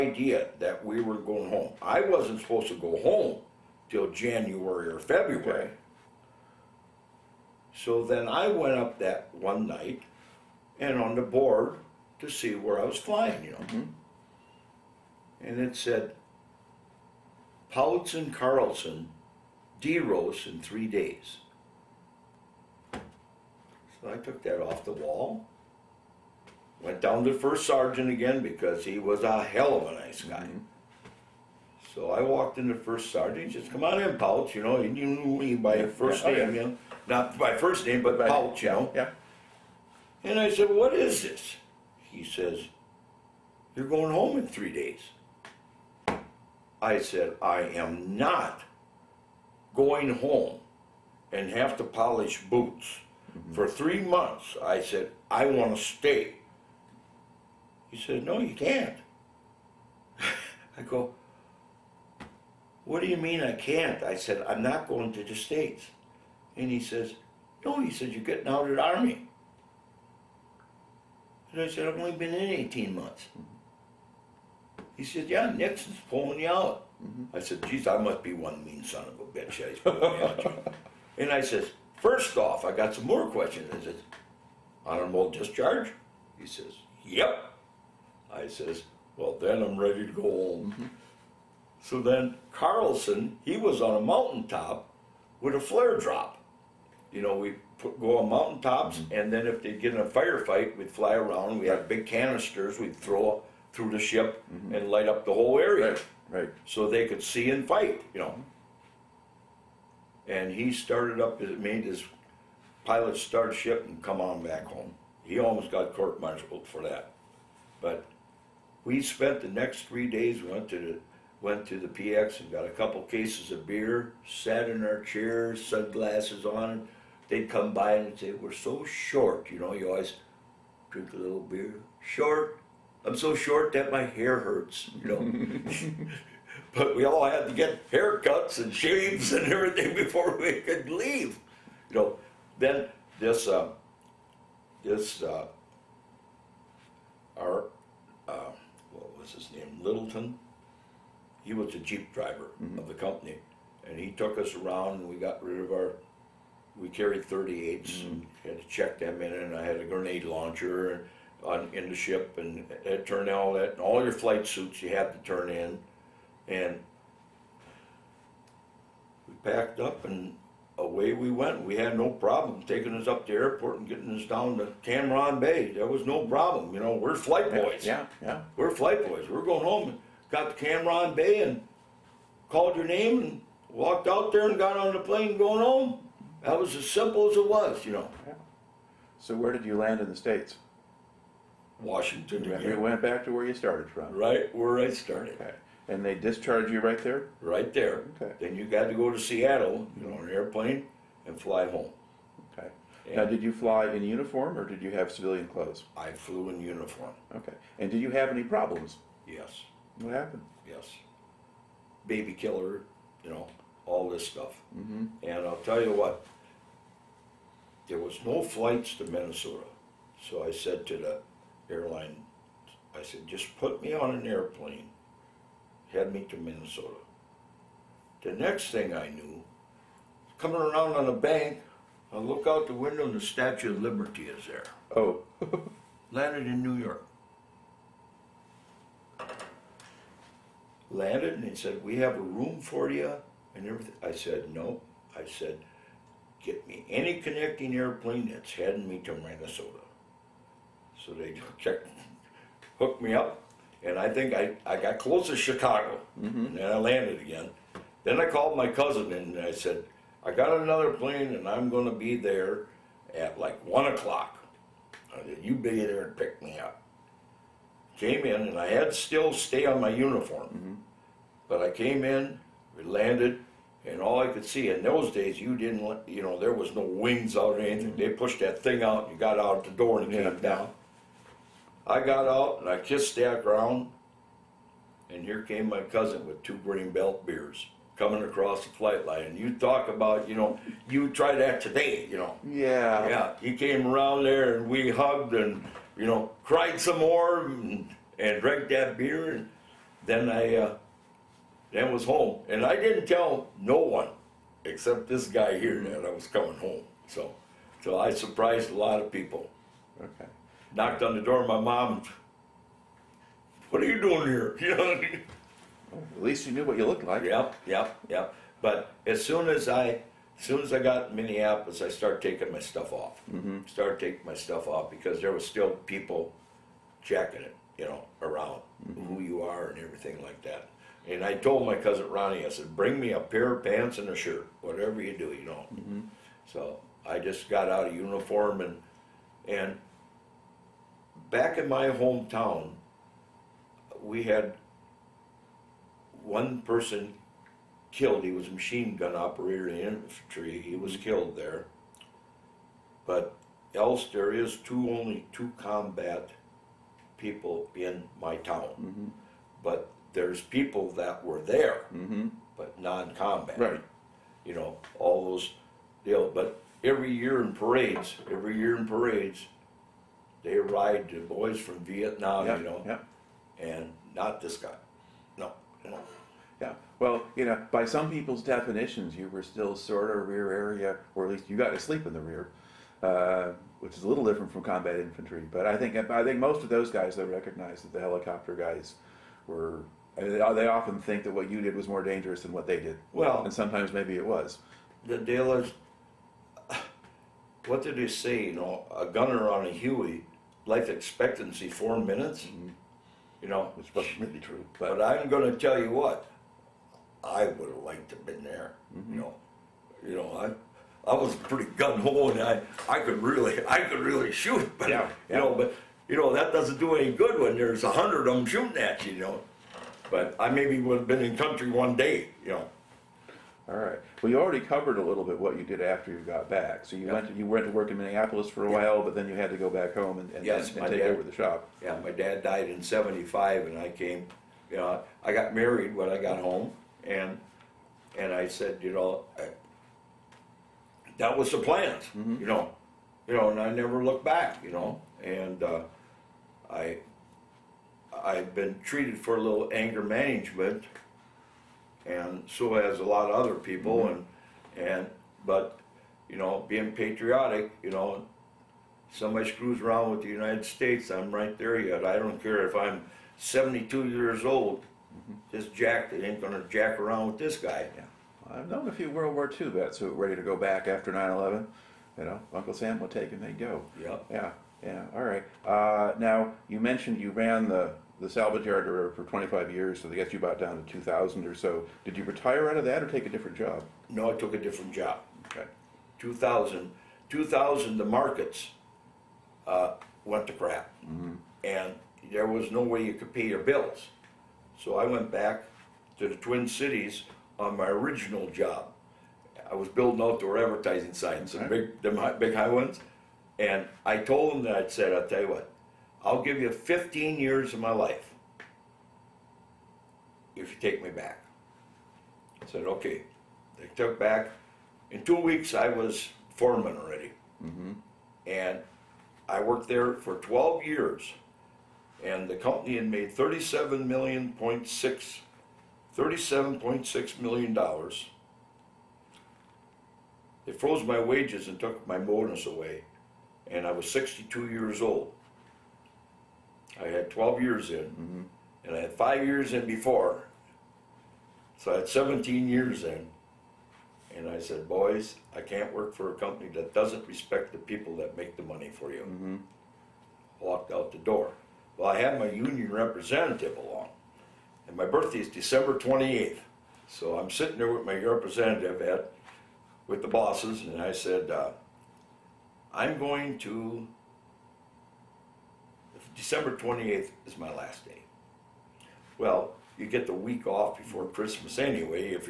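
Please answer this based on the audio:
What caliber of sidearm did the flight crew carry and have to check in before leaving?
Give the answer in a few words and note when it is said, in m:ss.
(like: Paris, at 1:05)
38, at 2:37.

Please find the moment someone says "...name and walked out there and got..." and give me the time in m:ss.
3:02.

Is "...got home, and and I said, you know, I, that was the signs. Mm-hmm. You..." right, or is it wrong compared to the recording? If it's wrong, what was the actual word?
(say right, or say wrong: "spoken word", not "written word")
wrong: "plans", not "signs".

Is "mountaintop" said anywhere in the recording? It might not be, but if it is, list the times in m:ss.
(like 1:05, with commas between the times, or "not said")
1:34, 1:38.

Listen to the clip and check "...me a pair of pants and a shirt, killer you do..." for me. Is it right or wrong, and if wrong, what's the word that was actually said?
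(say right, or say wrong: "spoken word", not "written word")
wrong: "whatever", not "killer".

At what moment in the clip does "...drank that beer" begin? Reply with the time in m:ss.
4:58.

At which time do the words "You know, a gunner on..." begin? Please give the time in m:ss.
6:38.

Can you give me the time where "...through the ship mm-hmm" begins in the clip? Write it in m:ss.
1:43.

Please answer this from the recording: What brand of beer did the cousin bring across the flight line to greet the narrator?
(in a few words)
Grain Belt.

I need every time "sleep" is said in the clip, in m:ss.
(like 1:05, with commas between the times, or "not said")
6:21.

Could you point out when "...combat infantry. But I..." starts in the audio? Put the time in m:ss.
6:24.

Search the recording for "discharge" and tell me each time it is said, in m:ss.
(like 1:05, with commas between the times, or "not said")
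1:25, 3:16.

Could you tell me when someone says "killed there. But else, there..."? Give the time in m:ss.
5:51.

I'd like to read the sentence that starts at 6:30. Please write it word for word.
they often think that what you did was more dangerous than what they did.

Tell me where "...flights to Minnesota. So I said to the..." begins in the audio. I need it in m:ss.
3:38.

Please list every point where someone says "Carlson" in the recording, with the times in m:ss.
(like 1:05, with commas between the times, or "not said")
0:18, 1:32.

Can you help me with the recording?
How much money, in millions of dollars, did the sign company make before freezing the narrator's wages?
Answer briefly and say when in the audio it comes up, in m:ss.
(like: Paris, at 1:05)
37.6 million, at 8:46.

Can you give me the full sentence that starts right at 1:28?
I says, well, then I'm ready to go home.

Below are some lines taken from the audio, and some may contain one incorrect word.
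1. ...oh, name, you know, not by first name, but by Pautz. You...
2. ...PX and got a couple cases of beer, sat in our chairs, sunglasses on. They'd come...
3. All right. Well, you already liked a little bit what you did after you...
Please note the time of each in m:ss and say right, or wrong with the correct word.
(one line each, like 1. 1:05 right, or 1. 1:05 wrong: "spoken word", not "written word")
1. 0:36 right
2. 2:01 right
3. 7:03 wrong: "covered", not "liked".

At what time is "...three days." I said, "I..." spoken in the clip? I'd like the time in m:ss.
0:44.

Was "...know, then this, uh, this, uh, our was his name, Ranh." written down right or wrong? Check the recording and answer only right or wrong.
wrong.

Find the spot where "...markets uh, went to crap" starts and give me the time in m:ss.
8:08.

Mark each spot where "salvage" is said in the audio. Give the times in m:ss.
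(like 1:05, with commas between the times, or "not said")
7:58.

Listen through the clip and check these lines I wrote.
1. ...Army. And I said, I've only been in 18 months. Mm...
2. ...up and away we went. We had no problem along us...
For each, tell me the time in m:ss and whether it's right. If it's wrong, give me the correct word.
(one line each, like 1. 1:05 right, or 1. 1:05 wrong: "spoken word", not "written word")
1. 1:08 right
2. 2:49 wrong: "taking", not "along".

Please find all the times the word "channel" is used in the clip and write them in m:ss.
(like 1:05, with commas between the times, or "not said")
not said.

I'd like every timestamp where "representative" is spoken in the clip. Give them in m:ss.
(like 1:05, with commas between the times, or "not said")
9:12, 9:18.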